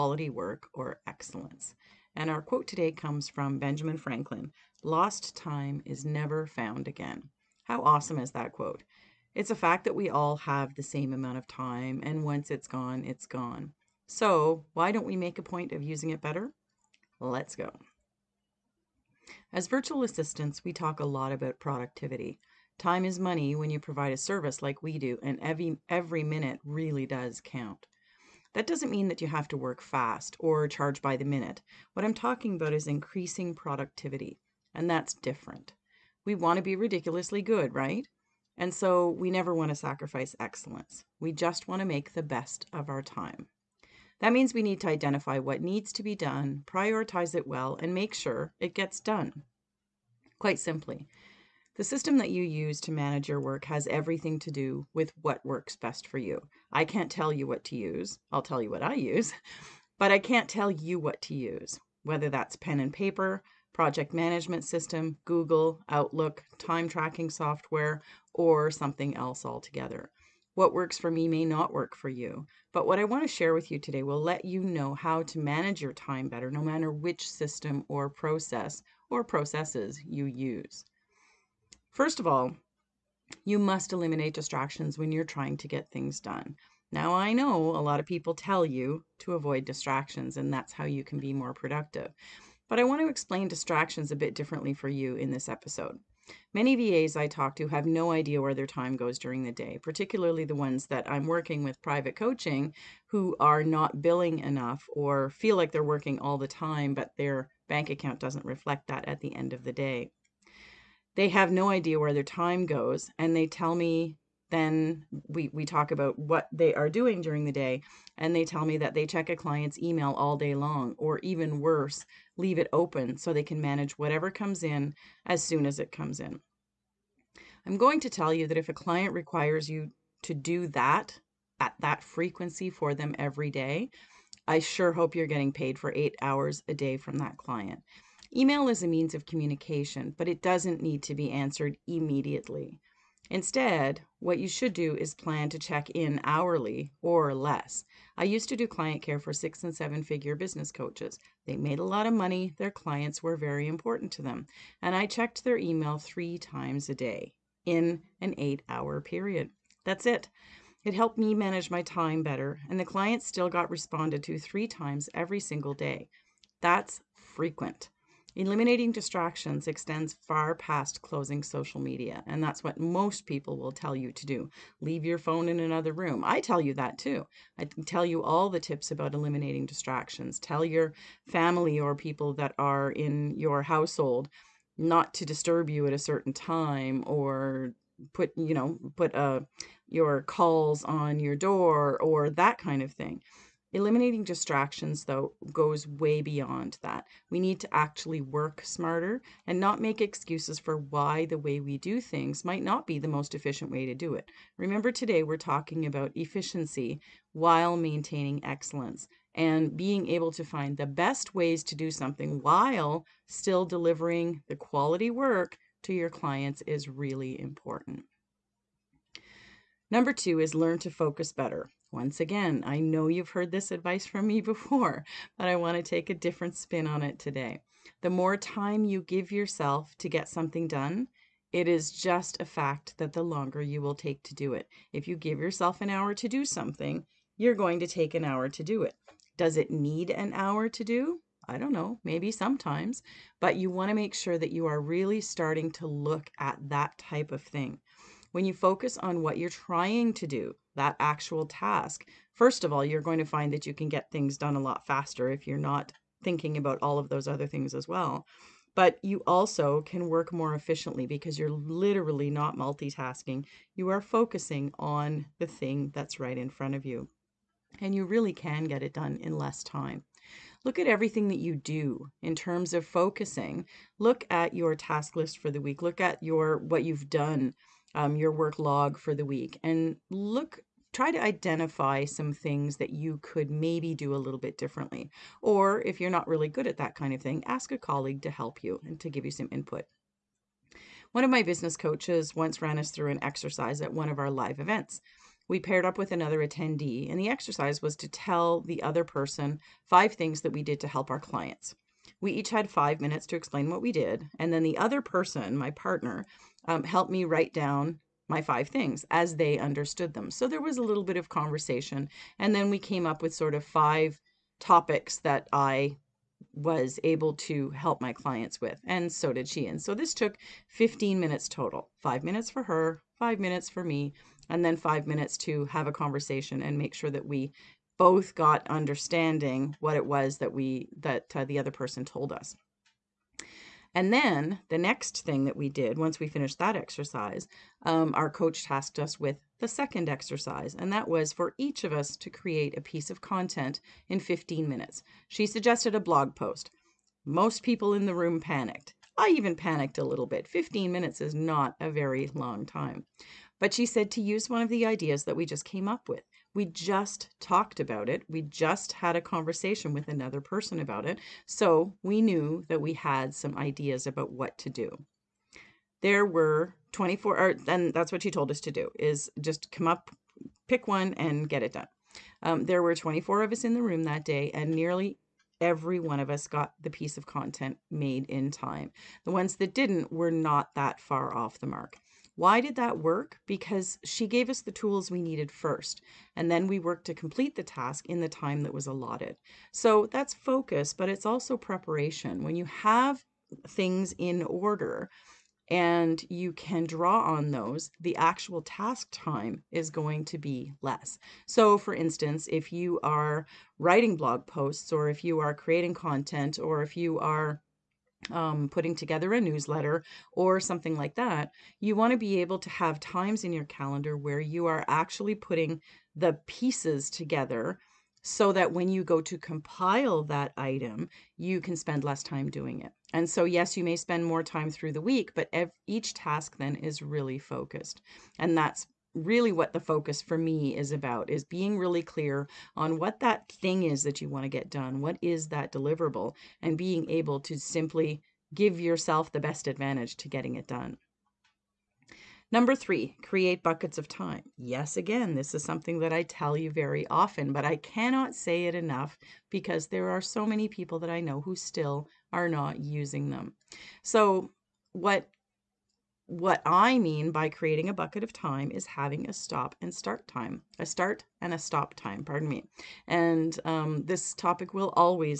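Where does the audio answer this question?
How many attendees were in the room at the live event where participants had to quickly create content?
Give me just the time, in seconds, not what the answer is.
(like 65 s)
372 s.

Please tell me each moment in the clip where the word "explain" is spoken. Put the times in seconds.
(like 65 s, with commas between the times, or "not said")
93 s, 303 s.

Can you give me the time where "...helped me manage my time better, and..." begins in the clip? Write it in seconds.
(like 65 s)
160 s.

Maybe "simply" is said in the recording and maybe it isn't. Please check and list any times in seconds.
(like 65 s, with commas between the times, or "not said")
50 s, 437 s.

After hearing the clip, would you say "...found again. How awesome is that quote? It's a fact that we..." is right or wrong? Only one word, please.
right.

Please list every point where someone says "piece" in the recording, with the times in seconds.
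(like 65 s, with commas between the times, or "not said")
342 s, 376 s, 416 s.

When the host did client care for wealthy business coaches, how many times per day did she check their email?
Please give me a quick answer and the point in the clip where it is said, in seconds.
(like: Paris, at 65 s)
3, at 155 s.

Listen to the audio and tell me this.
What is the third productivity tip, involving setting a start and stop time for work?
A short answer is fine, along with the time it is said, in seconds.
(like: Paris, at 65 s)
Create buckets of time, at 443 s.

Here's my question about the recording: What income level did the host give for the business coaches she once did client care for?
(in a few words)
six and seven figure.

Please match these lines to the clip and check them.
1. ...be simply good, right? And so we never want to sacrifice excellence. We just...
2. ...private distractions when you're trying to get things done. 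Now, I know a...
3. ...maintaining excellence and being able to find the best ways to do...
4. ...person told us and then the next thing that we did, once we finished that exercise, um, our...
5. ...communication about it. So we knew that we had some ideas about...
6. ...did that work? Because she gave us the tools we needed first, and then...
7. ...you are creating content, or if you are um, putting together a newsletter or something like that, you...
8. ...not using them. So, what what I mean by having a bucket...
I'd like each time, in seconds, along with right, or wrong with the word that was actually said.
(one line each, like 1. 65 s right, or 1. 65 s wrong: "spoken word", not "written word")
1. 36 s wrong: "ridiculously", not "simply"
2. 83 s wrong: "eliminate", not "private"
3. 207 s right
4. 331 s right
5. 360 s wrong: "person", not "communication"
6. 382 s right
7. 405 s right
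8. 452 s wrong: "creating", not "having".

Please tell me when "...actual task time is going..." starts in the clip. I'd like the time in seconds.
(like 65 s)
398 s.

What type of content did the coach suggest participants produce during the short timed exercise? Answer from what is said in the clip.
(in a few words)
A blog post.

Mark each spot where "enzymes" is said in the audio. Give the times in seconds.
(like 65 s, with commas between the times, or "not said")
not said.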